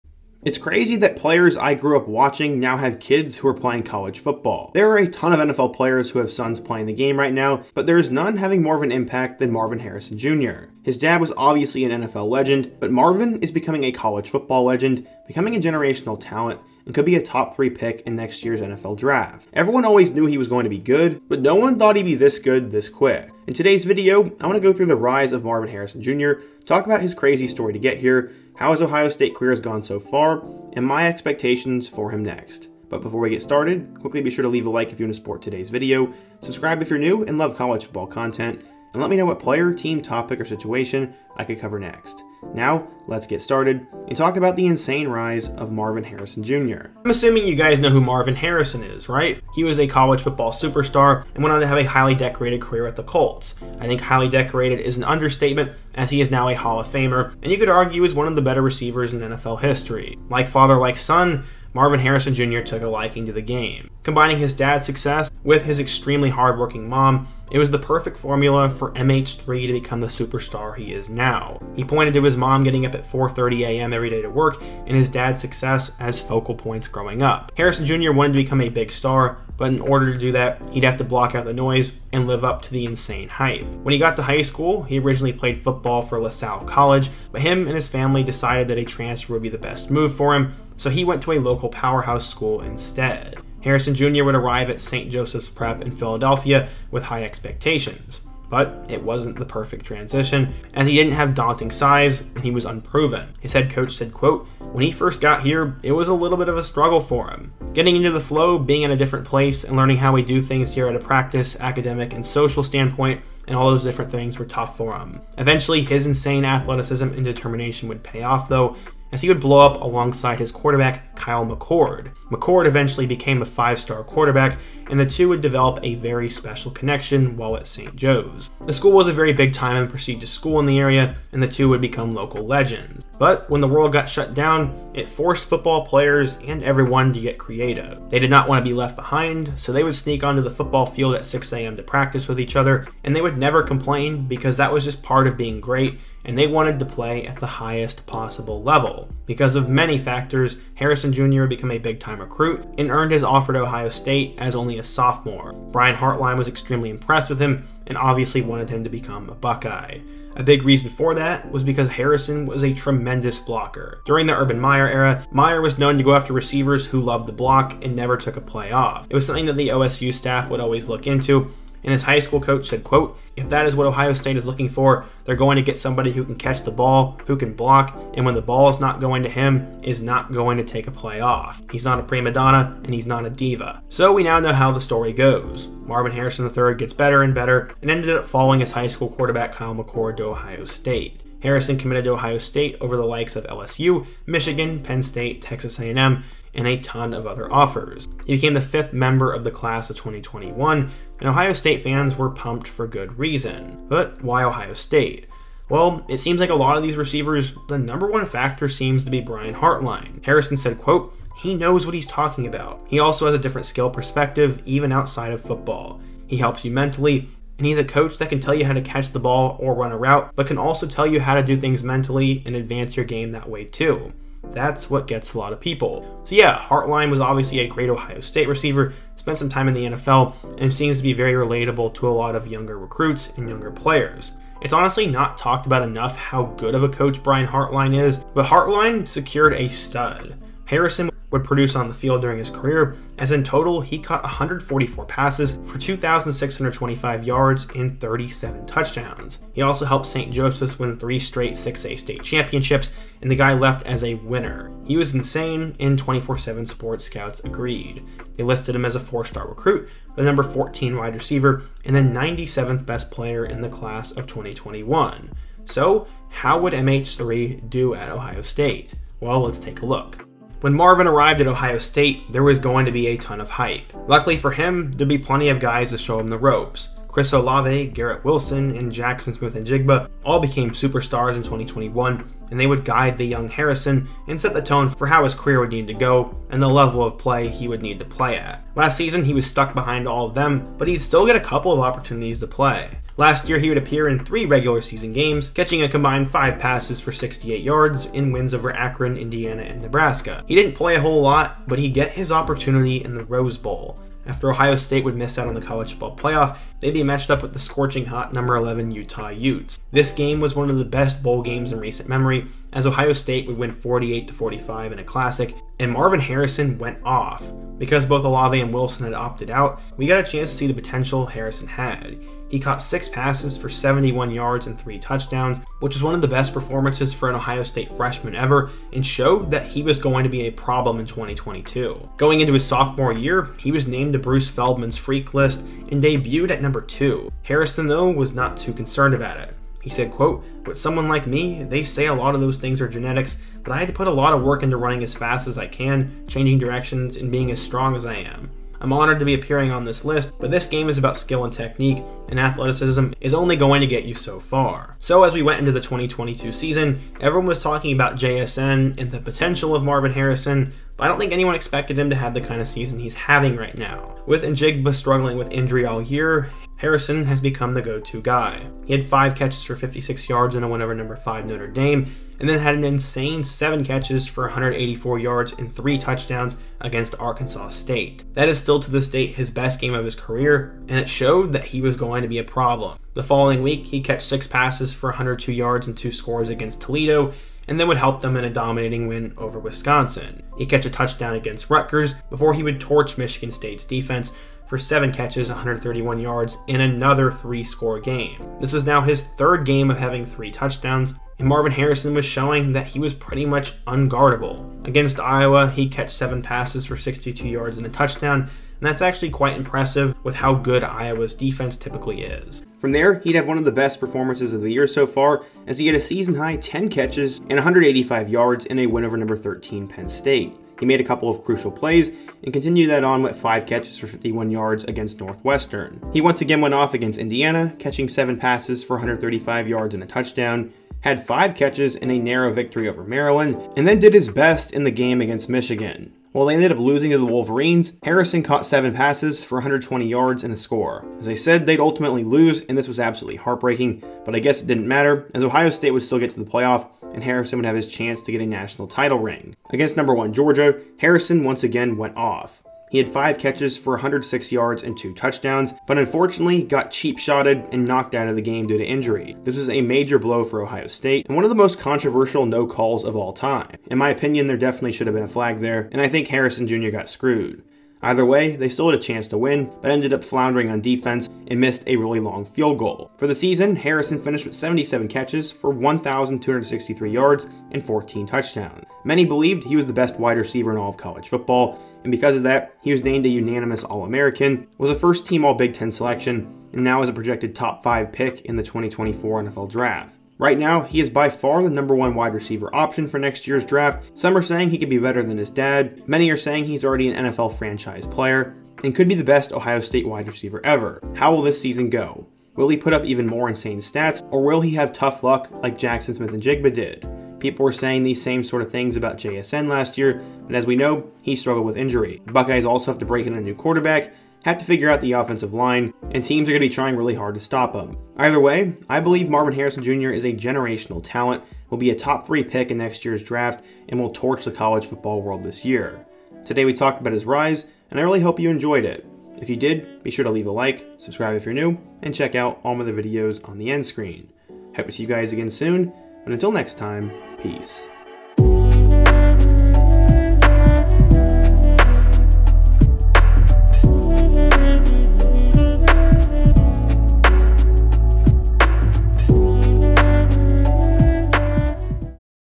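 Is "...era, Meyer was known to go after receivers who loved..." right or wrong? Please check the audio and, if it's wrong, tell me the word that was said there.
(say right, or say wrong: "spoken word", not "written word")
right.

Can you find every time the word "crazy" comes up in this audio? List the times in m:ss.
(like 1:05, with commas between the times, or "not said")
0:00, 0:27.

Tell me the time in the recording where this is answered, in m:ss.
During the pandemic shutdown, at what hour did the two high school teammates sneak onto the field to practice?
2:21.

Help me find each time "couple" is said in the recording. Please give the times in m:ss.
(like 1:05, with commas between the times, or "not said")
4:51, 7:01.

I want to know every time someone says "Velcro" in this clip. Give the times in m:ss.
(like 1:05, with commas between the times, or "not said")
not said.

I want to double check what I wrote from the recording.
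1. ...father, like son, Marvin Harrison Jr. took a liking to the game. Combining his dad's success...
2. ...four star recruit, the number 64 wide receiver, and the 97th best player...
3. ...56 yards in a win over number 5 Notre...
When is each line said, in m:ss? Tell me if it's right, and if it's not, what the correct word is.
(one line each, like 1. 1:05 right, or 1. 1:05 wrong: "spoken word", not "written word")
1. 1:00 right
2. 4:19 wrong: "14", not "64"
3. 6:09 right.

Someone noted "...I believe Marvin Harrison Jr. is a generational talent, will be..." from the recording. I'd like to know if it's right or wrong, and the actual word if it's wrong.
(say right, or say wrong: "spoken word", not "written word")
right.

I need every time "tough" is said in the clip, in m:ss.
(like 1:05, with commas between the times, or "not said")
1:54, 8:24.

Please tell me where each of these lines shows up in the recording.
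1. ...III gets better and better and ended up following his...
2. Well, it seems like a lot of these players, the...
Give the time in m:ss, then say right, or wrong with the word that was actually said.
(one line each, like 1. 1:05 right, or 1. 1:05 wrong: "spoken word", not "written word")
1. 3:06 right
2. 3:25 wrong: "receivers", not "players".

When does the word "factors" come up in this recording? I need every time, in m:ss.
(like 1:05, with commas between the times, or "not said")
2:29, 3:28.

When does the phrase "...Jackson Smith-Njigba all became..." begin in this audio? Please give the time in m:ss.
4:38.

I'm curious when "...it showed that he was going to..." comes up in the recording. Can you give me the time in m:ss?
6:20.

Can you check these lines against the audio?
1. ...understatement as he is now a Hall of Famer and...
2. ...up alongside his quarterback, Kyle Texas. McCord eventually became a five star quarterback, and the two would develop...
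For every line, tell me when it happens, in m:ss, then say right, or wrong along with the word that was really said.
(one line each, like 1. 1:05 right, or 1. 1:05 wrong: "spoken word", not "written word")
1. 0:55 right
2. 1:59 wrong: "McCord", not "Texas".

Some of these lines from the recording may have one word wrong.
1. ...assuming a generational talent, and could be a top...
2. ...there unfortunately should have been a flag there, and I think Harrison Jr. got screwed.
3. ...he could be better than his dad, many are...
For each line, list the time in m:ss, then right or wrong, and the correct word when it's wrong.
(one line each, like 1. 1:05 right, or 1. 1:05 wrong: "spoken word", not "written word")
1. 0:15 wrong: "becoming", not "assuming"
2. 7:44 wrong: "definitely", not "unfortunately"
3. 8:14 right.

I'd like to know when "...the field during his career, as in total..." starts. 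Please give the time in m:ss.
4:01.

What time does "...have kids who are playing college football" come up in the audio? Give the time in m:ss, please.
0:02.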